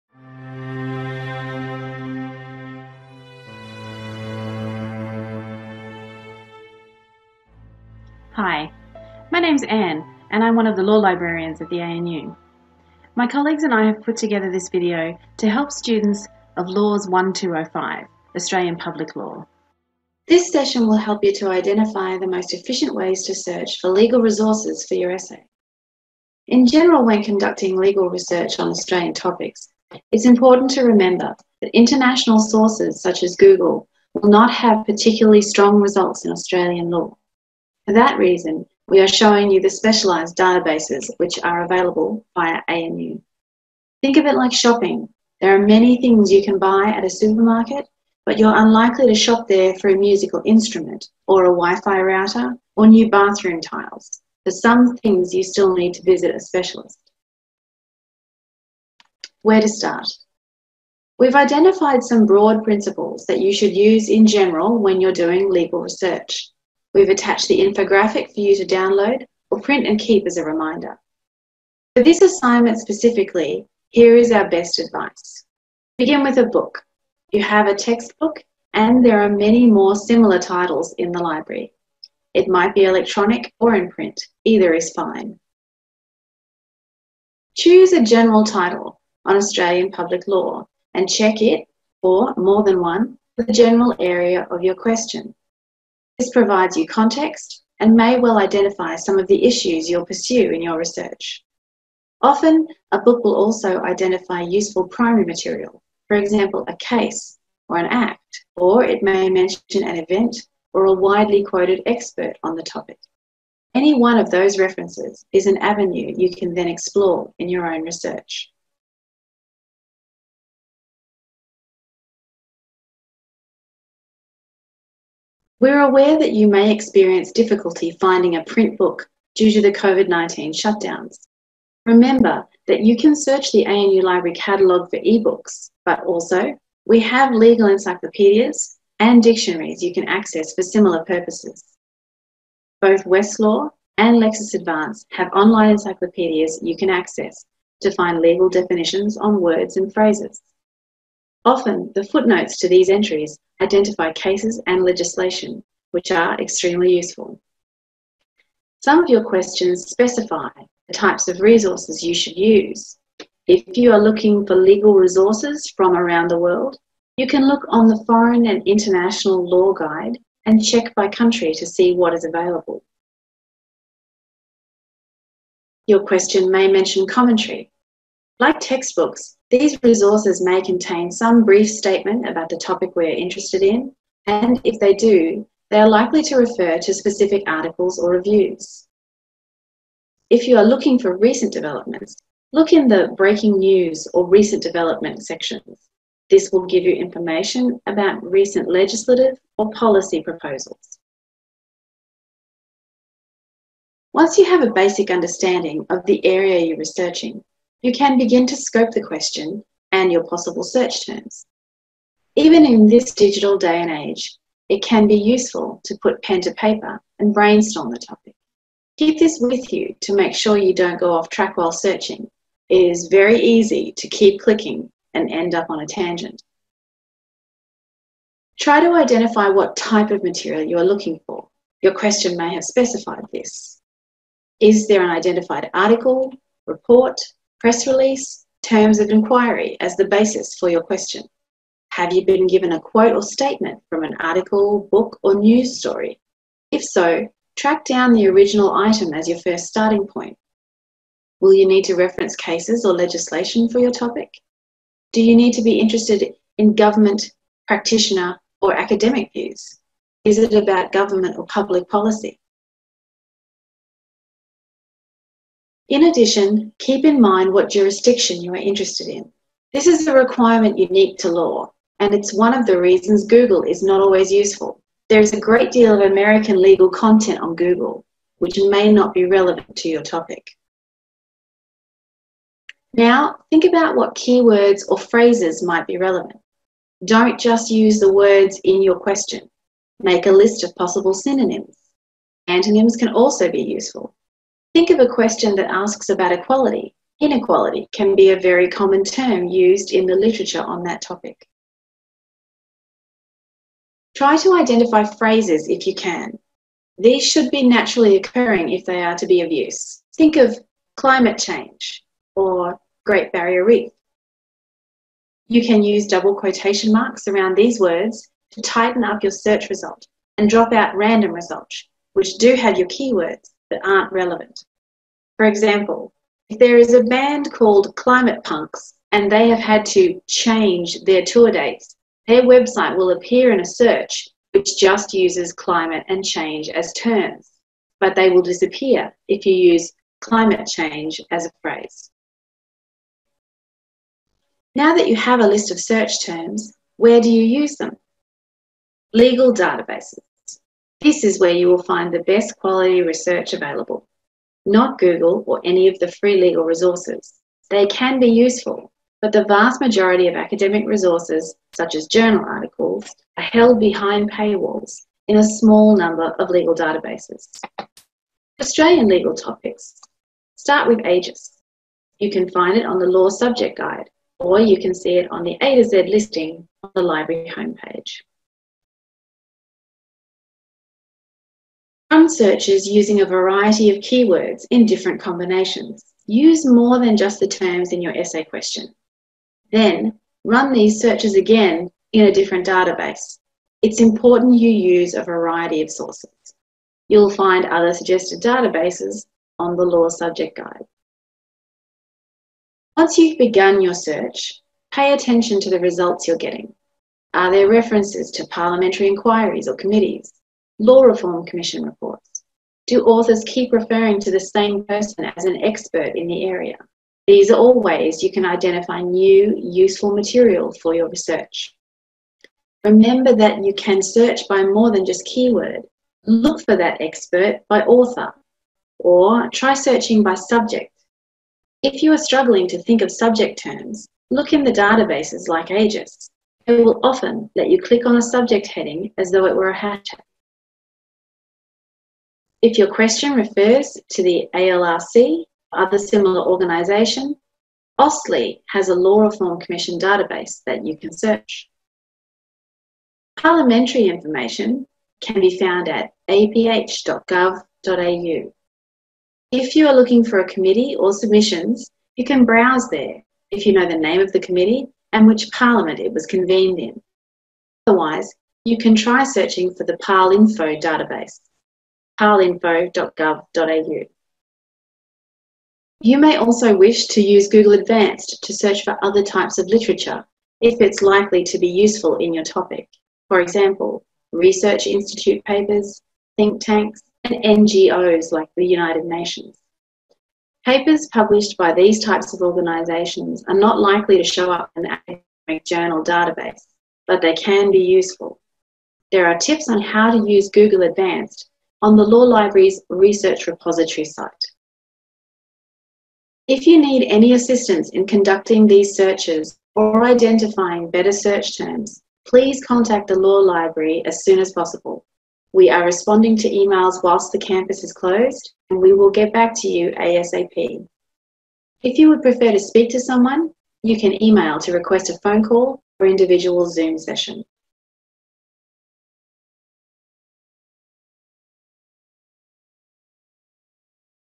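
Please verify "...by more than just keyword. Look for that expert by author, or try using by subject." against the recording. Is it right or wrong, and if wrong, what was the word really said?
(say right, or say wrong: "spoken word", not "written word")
wrong: "searching", not "using".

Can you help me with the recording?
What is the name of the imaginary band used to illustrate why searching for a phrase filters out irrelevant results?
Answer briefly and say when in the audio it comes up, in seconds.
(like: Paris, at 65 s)
Climate Punks, at 327 s.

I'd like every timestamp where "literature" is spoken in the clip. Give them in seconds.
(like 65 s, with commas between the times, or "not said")
300 s, 479 s.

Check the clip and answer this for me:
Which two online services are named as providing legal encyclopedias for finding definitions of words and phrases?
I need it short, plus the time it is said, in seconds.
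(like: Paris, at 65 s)
Westlaw and Lexis Advance, at 143 s.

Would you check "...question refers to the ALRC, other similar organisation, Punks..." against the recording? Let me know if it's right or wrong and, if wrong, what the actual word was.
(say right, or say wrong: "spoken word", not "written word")
wrong: "AustLII", not "Punks".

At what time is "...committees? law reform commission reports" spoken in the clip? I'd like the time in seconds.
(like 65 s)
409 s.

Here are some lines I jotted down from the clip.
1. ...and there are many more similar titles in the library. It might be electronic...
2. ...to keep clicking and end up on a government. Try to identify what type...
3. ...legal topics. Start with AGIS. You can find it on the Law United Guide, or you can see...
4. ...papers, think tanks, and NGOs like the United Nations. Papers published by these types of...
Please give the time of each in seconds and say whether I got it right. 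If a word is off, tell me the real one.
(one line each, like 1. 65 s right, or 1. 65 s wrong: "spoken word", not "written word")
1. 78 s right
2. 223 s wrong: "tangent", not "government"
3. 369 s wrong: "Subject", not "United"
4. 485 s right.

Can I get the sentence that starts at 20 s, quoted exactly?
This session will help you to identify the most efficient ways to search for legal resources for your essay.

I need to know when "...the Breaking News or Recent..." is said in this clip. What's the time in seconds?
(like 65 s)
192 s.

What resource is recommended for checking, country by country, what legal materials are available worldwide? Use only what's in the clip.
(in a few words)
Foreign and International Law Guide.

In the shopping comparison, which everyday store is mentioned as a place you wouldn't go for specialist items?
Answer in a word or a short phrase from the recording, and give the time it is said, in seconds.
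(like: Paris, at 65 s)
supermarket, at 47 s.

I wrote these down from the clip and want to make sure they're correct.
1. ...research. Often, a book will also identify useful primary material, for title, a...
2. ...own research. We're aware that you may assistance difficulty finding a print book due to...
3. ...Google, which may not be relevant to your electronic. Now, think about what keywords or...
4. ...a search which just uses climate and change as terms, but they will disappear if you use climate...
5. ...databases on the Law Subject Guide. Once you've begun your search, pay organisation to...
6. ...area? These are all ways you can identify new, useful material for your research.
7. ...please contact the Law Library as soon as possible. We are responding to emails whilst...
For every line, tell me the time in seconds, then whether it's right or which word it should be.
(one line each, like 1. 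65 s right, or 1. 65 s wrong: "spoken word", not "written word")
1. 100 s wrong: "example", not "title"
2. 117 s wrong: "experience", not "assistance"
3. 277 s wrong: "topic", not "electronic"
4. 333 s right
5. 398 s wrong: "attention", not "organisation"
6. 416 s right
7. 512 s right.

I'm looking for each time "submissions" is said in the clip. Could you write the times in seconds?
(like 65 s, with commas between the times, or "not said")
461 s.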